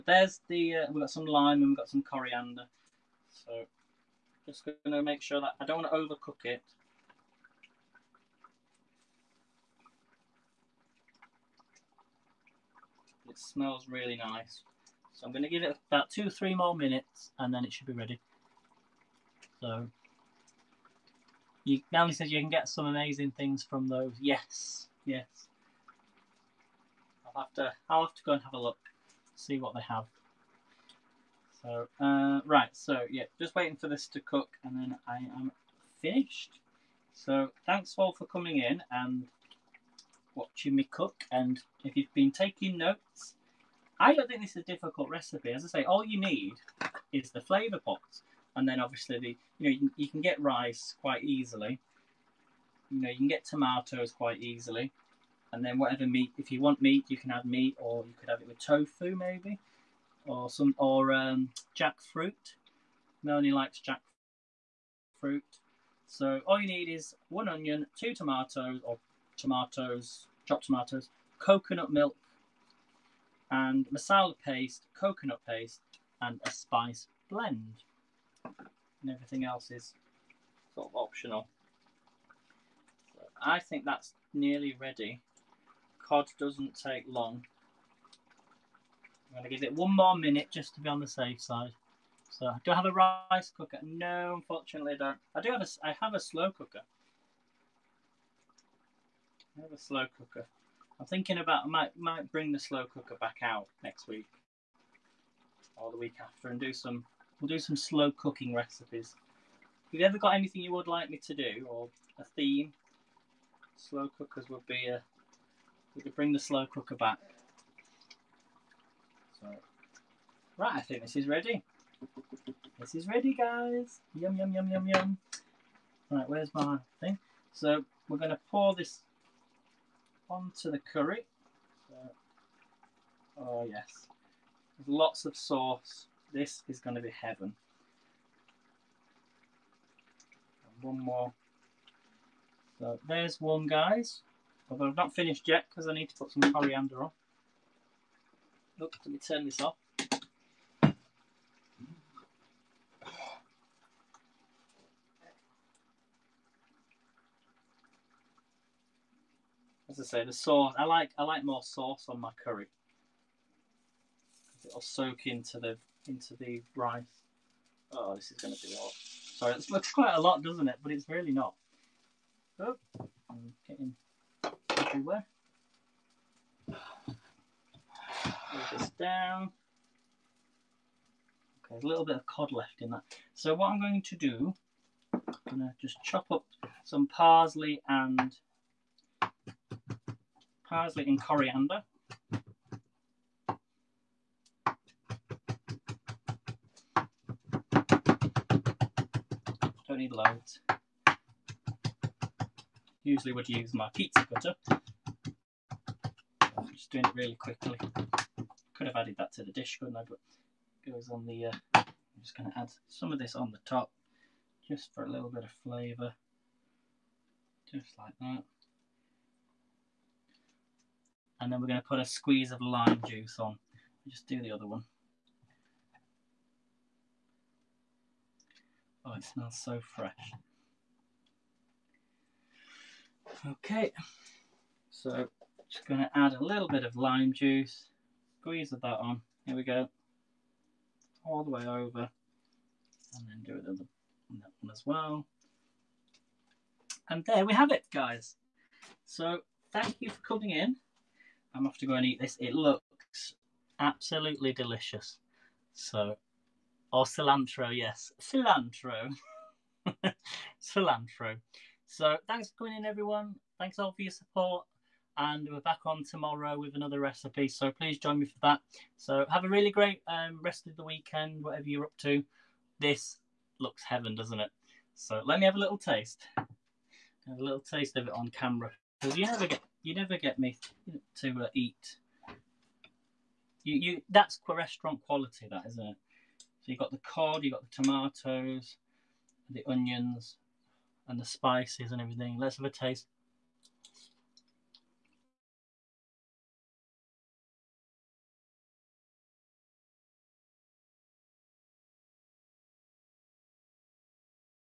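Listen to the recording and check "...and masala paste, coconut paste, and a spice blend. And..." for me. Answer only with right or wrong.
right.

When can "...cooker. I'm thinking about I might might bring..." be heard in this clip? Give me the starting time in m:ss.
1:40.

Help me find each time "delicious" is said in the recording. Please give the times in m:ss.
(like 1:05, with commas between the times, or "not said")
4:14.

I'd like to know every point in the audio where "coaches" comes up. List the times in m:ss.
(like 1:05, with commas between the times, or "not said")
not said.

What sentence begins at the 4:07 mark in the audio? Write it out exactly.
And there we have it, guys.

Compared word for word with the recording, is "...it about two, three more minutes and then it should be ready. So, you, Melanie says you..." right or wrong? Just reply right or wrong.
right.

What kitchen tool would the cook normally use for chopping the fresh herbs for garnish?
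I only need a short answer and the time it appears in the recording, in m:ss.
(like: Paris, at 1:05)
pizza cutter, at 3:23.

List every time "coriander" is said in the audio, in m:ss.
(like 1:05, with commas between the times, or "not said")
0:02, 2:26, 3:11.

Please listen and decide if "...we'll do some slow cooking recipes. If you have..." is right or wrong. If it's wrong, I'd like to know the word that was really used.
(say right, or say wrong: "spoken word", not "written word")
right.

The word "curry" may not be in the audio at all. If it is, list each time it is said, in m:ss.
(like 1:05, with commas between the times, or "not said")
2:10, 2:42.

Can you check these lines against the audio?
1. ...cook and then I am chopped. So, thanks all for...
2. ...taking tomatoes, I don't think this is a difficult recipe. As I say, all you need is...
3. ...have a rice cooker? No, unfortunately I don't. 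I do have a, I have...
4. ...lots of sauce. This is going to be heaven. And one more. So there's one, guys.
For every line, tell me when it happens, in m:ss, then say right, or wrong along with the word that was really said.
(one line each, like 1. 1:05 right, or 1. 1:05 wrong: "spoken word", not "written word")
1. 0:34 wrong: "finished", not "chopped"
2. 0:42 wrong: "notes", not "tomatoes"
3. 1:32 right
4. 2:14 right.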